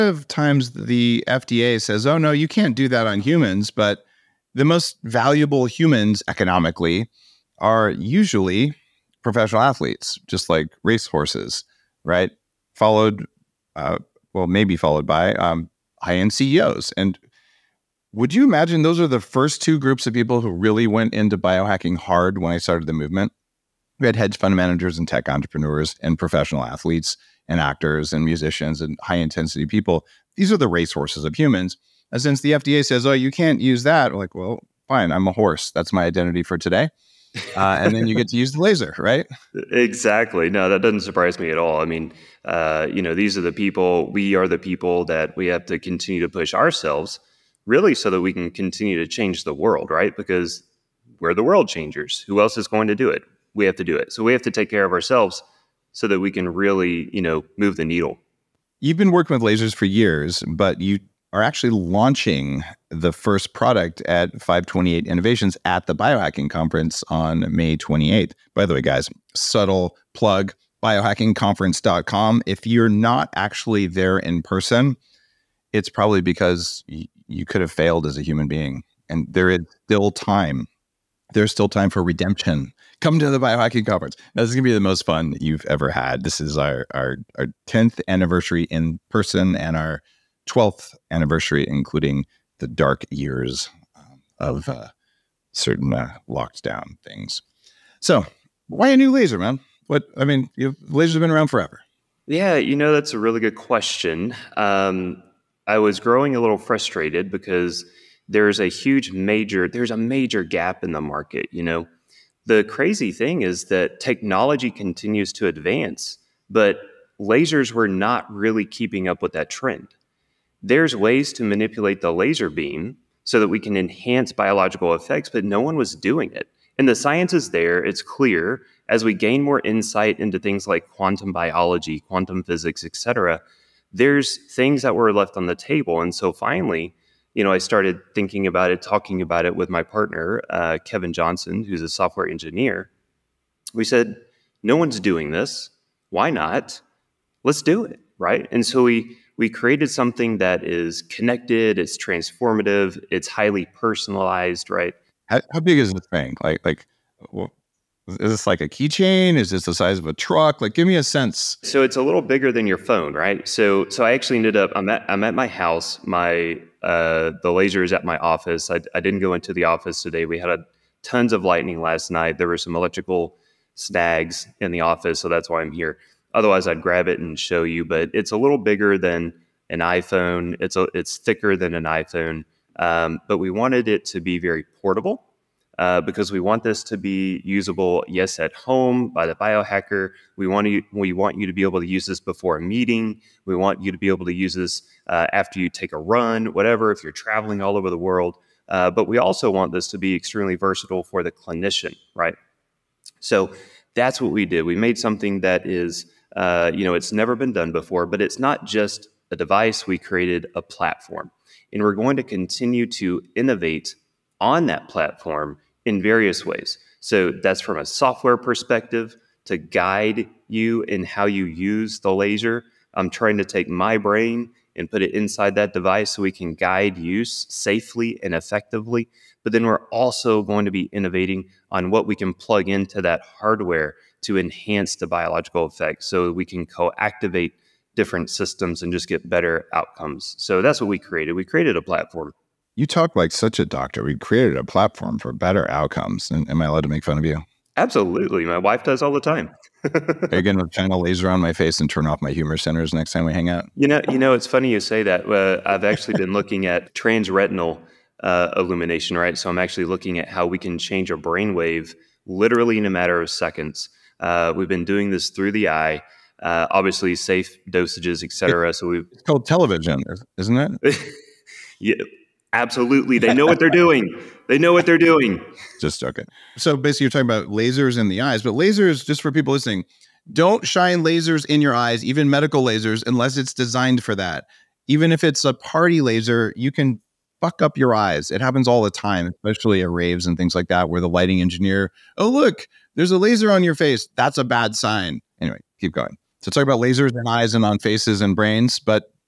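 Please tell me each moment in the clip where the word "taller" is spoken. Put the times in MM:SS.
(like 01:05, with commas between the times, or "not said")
not said.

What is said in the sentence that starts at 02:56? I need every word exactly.
Otherwise, I'd grab it and show you, but it's a little bigger than an iPhone.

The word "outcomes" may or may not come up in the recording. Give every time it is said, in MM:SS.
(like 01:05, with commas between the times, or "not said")
03:59, 04:05.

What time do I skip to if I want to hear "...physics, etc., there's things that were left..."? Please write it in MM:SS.
02:12.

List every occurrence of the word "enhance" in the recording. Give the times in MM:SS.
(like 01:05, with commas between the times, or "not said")
02:03, 03:54.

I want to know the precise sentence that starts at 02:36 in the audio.
Like like well, is this like a keychain?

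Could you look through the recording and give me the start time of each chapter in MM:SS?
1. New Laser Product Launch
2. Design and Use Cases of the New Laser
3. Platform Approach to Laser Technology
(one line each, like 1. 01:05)
1. 00:55
2. 02:35
3. 04:05.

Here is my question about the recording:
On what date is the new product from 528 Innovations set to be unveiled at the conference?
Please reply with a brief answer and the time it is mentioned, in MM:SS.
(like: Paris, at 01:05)
May 28th, at 01:07.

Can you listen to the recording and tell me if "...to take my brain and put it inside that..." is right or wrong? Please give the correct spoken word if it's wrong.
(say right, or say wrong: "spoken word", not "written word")
right.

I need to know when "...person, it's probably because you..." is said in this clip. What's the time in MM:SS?
01:14.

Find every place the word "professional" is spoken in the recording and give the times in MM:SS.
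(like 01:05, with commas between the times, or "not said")
00:09, 00:26.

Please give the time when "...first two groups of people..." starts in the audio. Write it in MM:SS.
00:19.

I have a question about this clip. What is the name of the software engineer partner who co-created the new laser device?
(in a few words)
Kevin Johnson.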